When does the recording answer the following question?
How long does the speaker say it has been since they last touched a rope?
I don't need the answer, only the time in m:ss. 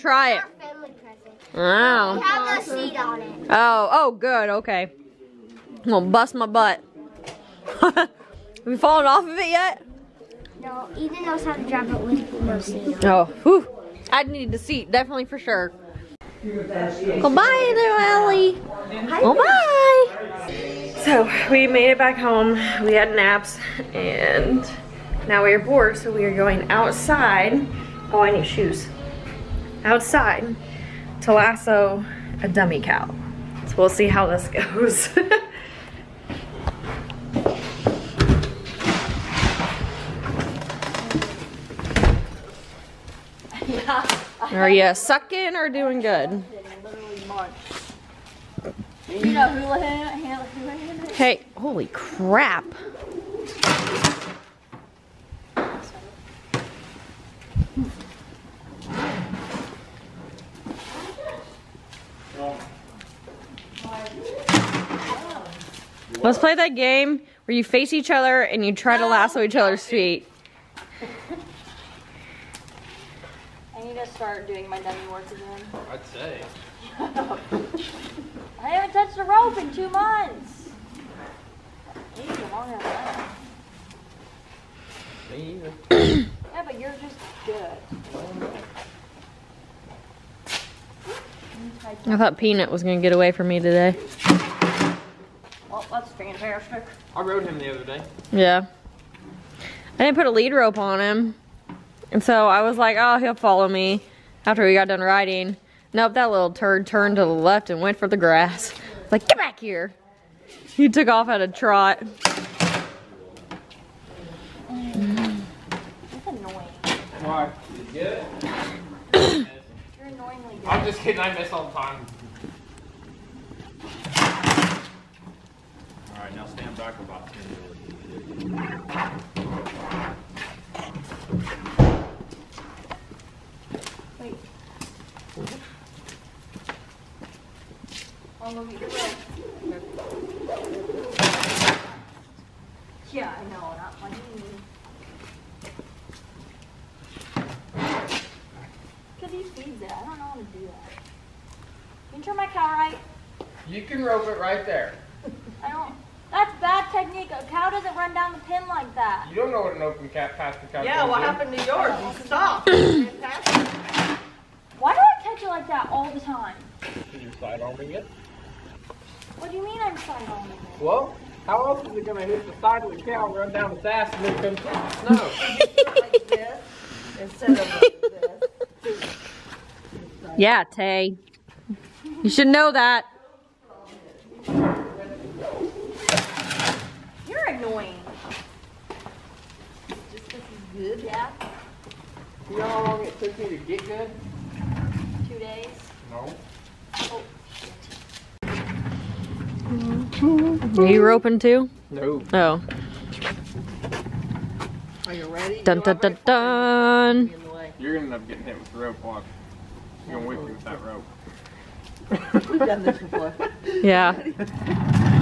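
1:19.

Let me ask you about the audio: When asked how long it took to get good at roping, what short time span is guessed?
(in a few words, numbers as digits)
2 days.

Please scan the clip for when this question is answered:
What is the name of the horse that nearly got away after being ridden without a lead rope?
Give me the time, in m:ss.
1:32.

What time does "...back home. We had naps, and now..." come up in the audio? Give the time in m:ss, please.
0:21.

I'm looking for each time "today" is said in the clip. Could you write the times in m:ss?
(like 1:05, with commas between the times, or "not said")
1:33.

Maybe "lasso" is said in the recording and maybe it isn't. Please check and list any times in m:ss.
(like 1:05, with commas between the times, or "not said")
0:31, 1:09.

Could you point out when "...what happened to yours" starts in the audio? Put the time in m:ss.
2:41.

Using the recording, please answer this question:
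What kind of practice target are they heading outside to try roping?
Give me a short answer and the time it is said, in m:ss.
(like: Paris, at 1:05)
dummy cow, at 0:32.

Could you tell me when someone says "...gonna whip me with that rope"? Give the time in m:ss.
3:30.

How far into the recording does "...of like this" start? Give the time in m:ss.
2:57.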